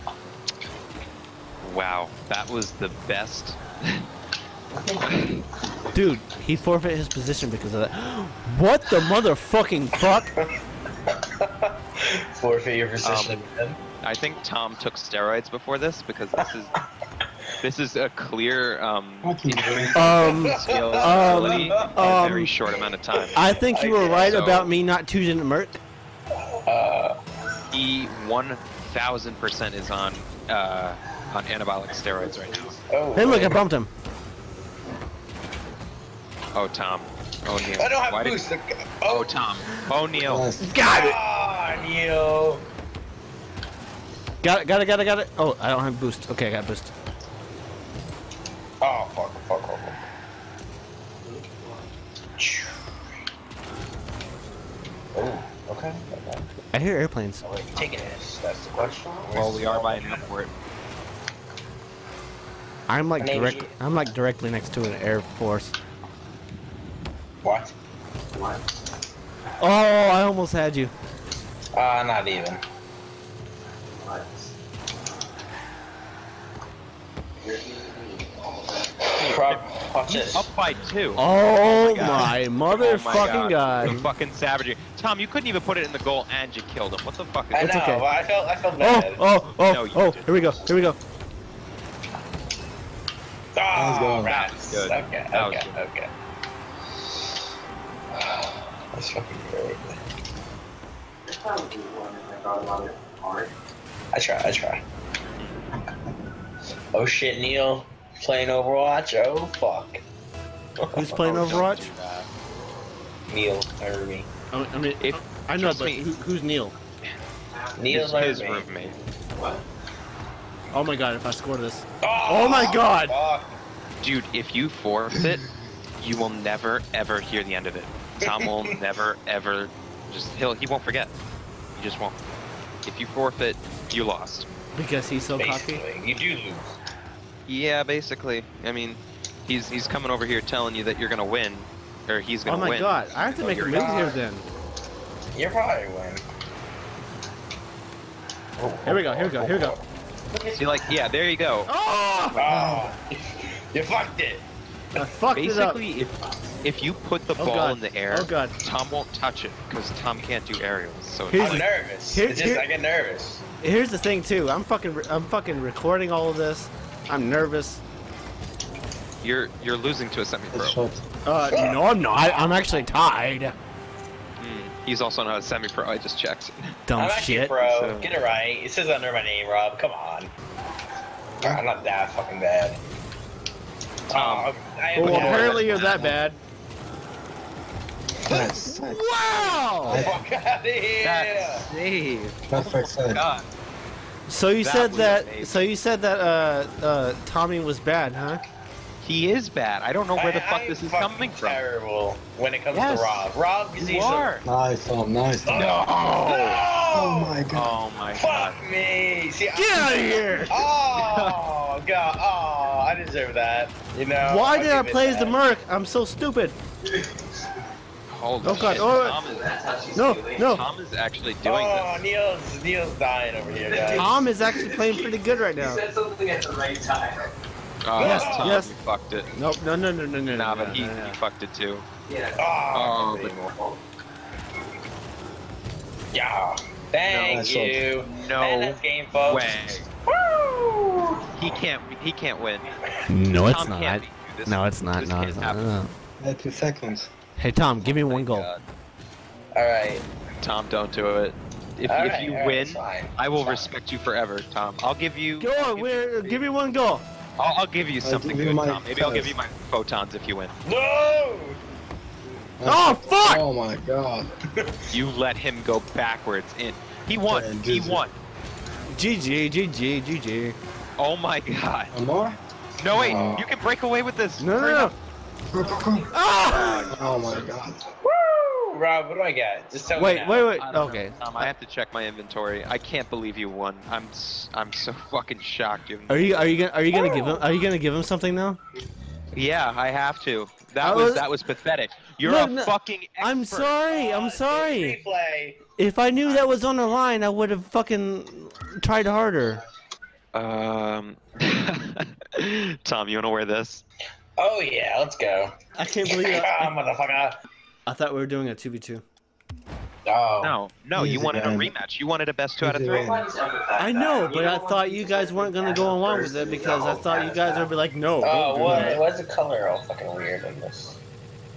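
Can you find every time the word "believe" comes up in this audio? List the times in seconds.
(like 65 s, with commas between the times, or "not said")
283 s, 306 s.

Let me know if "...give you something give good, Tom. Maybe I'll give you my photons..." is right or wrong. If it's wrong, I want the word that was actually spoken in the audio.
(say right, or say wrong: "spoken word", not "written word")
right.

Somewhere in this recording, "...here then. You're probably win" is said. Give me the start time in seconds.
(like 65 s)
143 s.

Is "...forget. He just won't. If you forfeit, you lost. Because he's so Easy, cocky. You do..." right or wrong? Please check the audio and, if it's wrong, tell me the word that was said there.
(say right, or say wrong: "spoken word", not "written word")
wrong: "Basically", not "Easy".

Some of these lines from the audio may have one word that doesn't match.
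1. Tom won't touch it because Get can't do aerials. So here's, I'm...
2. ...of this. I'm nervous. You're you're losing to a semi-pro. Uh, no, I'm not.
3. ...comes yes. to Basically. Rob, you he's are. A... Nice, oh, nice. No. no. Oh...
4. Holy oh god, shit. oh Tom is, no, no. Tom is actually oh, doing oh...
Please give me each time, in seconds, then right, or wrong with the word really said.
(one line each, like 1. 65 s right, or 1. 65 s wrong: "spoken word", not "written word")
1. 158 s wrong: "Tom", not "Get"
2. 166 s right
3. 202 s wrong: "Rob", not "Basically"
4. 218 s right.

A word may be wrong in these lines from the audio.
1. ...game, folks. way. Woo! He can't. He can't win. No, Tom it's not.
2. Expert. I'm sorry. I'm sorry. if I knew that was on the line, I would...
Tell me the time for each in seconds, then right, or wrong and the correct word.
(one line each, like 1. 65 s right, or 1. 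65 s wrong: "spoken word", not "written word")
1. 238 s right
2. 293 s right.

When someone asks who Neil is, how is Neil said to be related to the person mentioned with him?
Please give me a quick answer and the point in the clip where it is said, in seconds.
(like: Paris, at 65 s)
roommate, at 118 s.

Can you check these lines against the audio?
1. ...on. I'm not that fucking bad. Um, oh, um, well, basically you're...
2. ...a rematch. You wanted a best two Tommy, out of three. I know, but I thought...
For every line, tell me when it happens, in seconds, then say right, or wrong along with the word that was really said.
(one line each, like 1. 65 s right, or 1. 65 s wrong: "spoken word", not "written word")
1. 179 s wrong: "apparently", not "basically"
2. 311 s wrong: "Easy", not "Tommy".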